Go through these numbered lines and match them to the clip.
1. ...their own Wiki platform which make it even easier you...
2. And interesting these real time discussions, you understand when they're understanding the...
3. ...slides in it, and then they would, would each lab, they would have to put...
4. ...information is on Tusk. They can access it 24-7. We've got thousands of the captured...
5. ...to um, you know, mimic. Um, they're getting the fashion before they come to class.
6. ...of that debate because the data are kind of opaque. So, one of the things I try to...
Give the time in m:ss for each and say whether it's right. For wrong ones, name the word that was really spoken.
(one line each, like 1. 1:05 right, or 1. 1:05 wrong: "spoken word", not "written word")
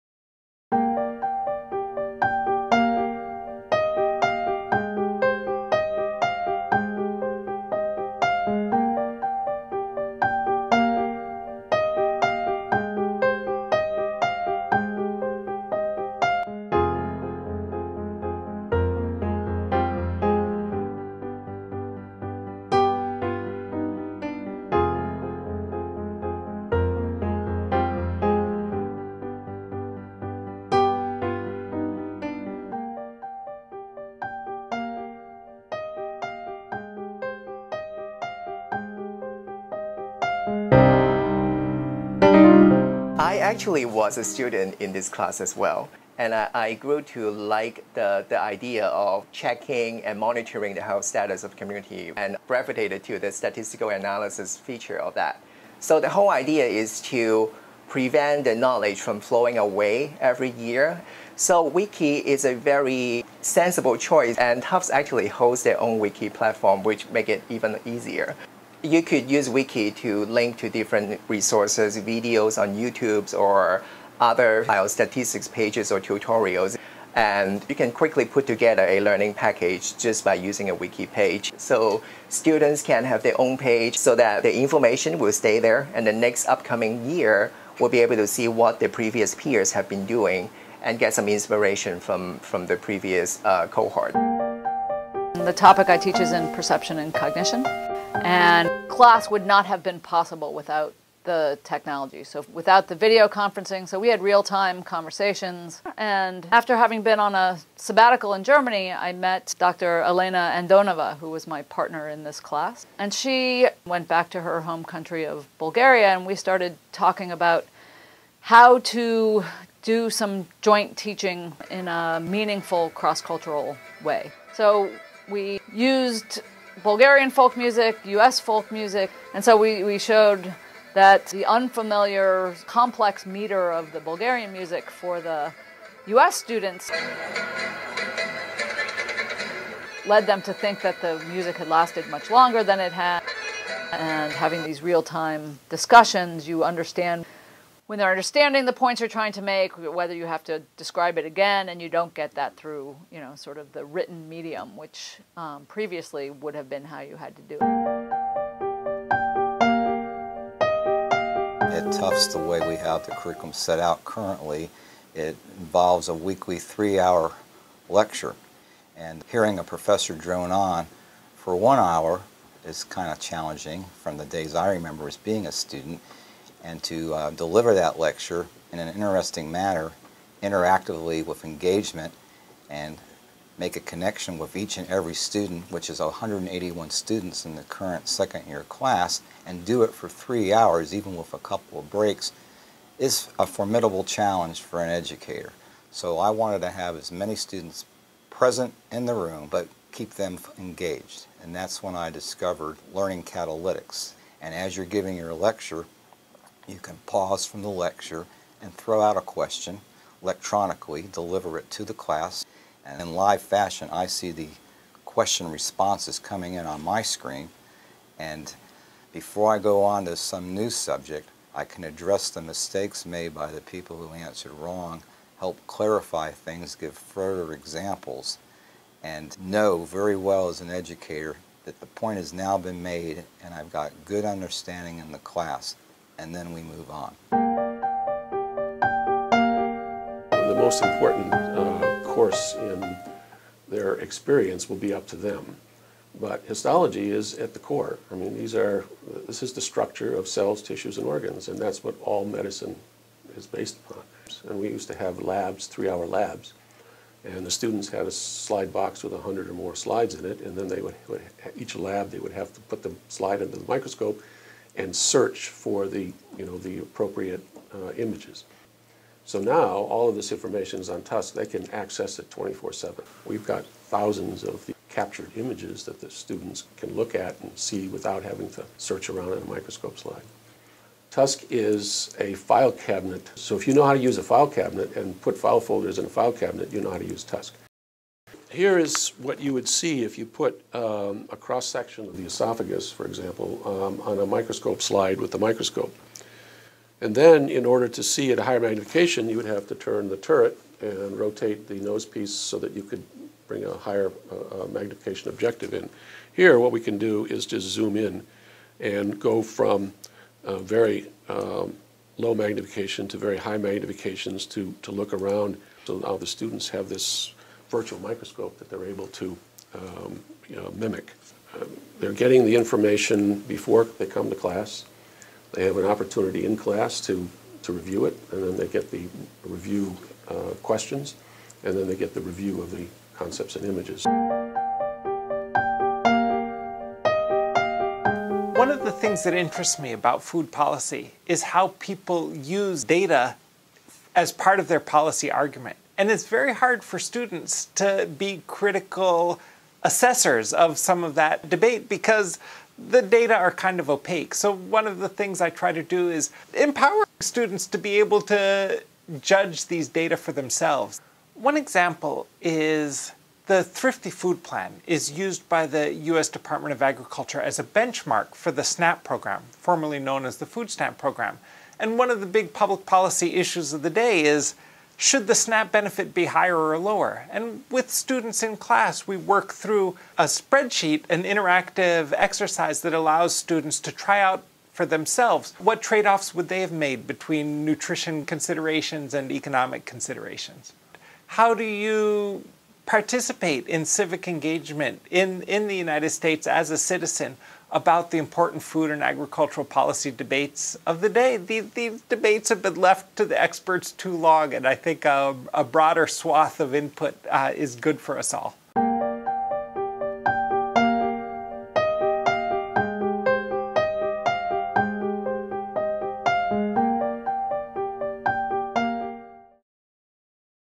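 1. 1:05 right
2. 2:23 wrong: "having", not "interesting"
3. 4:19 right
4. 4:30 right
5. 5:19 wrong: "information", not "fashion"
6. 5:51 right.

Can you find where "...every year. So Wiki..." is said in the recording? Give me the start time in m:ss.
1:00.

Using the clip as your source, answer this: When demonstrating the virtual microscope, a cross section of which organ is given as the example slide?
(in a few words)
esophagus.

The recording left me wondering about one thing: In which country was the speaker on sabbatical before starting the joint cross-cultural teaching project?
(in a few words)
Germany.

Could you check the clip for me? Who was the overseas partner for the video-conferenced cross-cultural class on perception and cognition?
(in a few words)
Dr. Elena Andonova.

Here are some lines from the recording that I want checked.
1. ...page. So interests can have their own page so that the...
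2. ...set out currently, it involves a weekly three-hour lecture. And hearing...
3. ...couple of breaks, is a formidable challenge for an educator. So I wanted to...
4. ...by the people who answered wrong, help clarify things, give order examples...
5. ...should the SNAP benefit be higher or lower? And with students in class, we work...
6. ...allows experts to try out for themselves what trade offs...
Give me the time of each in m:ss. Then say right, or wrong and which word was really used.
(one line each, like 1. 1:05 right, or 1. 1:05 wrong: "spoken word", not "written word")
1. 1:21 wrong: "students", not "interests"
2. 2:43 right
3. 3:11 right
4. 3:43 wrong: "further", not "order"
5. 6:15 right
6. 6:22 wrong: "students", not "experts".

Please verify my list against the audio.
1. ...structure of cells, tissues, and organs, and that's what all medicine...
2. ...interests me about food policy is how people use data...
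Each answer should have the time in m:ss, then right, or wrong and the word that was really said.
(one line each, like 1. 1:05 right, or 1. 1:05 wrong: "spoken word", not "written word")
1. 4:09 right
2. 5:39 right.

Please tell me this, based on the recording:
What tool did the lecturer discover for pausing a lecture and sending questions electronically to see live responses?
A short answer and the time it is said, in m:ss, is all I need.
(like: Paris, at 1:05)
Learning Catalytics, at 3:22.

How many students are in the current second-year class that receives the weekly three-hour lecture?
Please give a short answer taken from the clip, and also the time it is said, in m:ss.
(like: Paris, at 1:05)
181, at 3:05.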